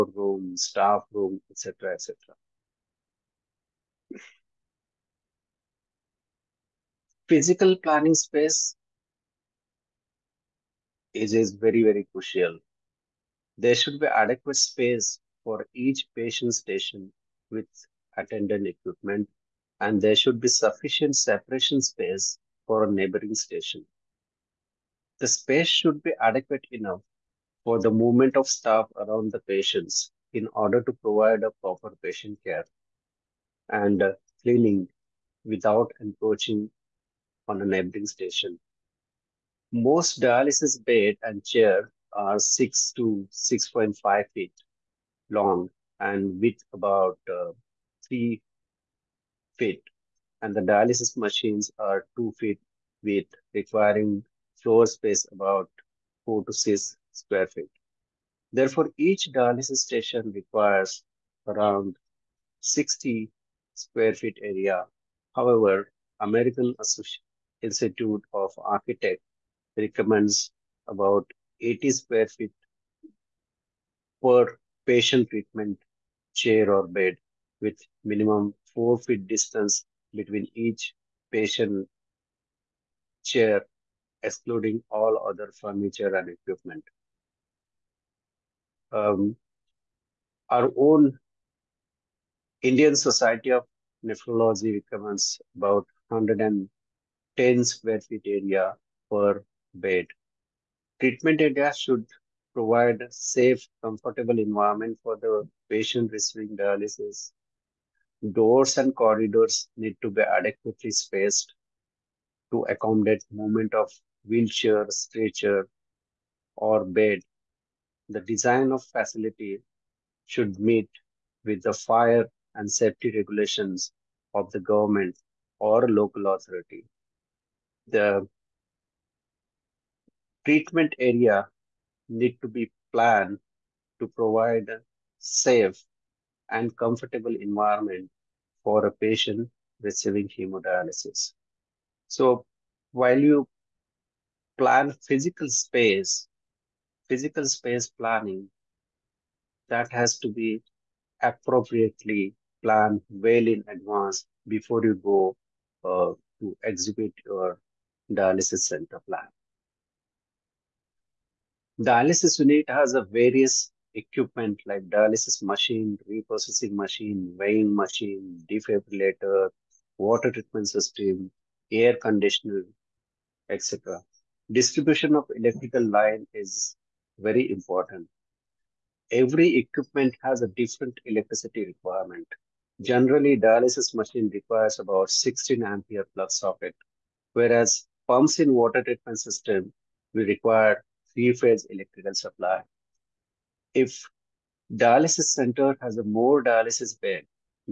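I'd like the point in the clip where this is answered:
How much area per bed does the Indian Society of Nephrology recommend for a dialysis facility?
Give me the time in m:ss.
1:36.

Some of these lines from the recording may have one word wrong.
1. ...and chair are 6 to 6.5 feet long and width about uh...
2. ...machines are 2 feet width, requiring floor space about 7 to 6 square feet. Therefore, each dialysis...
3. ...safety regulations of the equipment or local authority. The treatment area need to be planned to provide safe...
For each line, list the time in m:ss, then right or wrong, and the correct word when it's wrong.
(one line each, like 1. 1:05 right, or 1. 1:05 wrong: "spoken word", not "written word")
1. 0:41 right
2. 0:51 wrong: "4", not "7"
3. 2:02 wrong: "government", not "equipment".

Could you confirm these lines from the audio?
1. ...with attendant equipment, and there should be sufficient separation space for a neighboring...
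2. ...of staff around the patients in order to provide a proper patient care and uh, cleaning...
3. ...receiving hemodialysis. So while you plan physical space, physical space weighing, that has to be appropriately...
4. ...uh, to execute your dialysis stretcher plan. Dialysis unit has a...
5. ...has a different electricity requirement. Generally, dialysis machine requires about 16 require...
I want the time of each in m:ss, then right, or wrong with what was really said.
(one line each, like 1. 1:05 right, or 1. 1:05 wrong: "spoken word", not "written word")
1. 0:17 right
2. 0:28 right
3. 2:19 wrong: "planning", not "weighing"
4. 2:35 wrong: "center", not "stretcher"
5. 3:00 wrong: "ampere", not "require".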